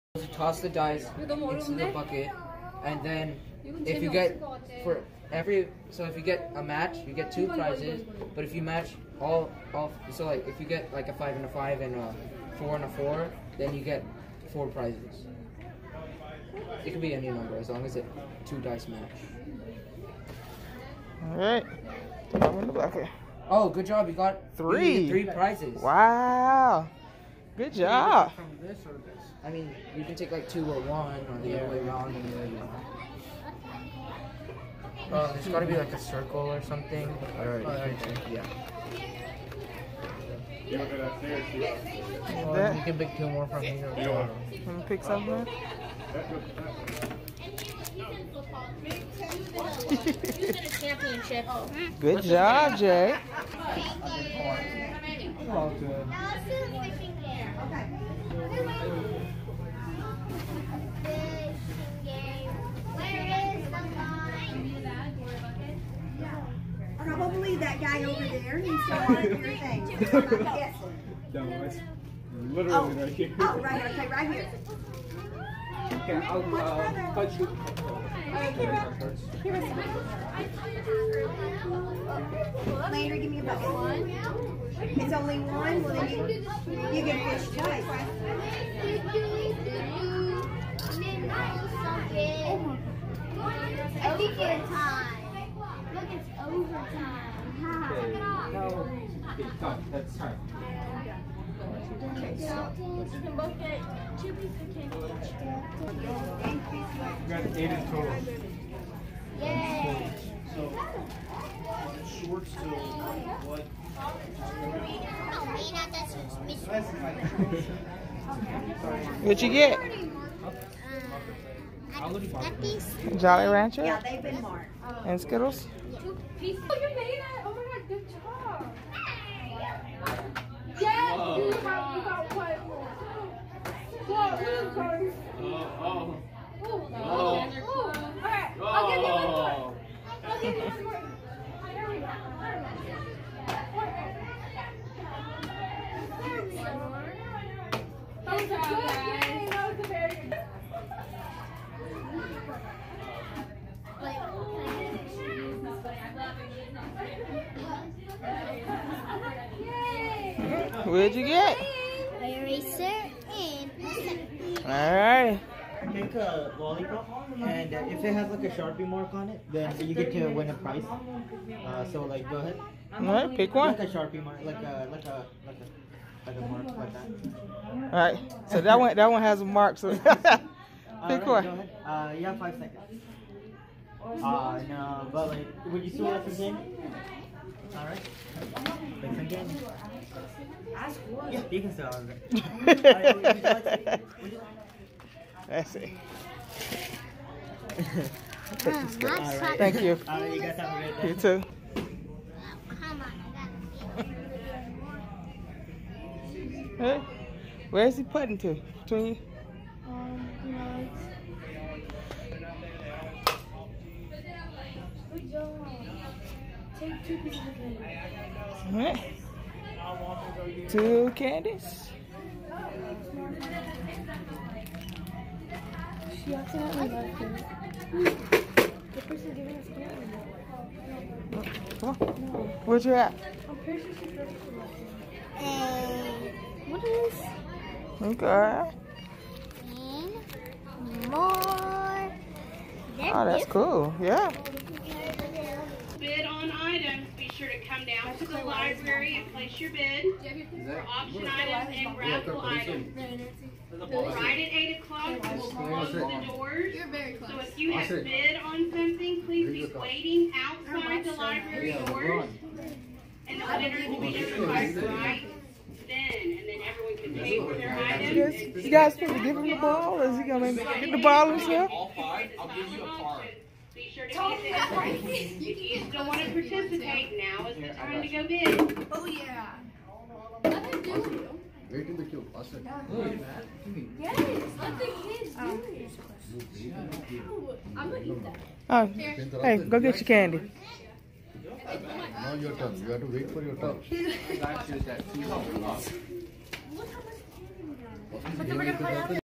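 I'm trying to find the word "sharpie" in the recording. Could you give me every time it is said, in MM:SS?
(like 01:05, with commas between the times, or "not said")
02:48, 02:53.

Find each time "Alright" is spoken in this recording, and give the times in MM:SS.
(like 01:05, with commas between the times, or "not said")
02:52, 02:57, 03:07.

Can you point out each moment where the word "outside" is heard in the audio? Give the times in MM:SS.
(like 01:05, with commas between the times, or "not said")
04:20.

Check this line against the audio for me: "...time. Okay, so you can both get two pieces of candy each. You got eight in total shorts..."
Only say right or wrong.
right.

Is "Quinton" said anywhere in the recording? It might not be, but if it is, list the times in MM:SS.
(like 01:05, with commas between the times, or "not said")
not said.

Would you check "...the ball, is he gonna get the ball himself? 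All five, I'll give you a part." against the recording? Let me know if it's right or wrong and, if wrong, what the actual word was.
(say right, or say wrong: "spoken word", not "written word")
right.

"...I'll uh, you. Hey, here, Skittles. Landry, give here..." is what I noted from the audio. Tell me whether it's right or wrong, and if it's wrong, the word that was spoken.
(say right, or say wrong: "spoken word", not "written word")
wrong: "Kira", not "Skittles".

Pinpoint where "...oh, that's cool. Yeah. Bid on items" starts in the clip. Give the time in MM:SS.
04:03.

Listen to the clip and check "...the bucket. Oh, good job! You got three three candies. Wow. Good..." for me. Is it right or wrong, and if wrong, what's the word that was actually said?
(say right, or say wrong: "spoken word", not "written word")
wrong: "prizes", not "candies".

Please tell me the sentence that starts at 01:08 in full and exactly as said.
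He's still one of your things.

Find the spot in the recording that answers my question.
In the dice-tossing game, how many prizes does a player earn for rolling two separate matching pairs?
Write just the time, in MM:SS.
00:14.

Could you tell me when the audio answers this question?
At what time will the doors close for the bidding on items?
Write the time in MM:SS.
04:14.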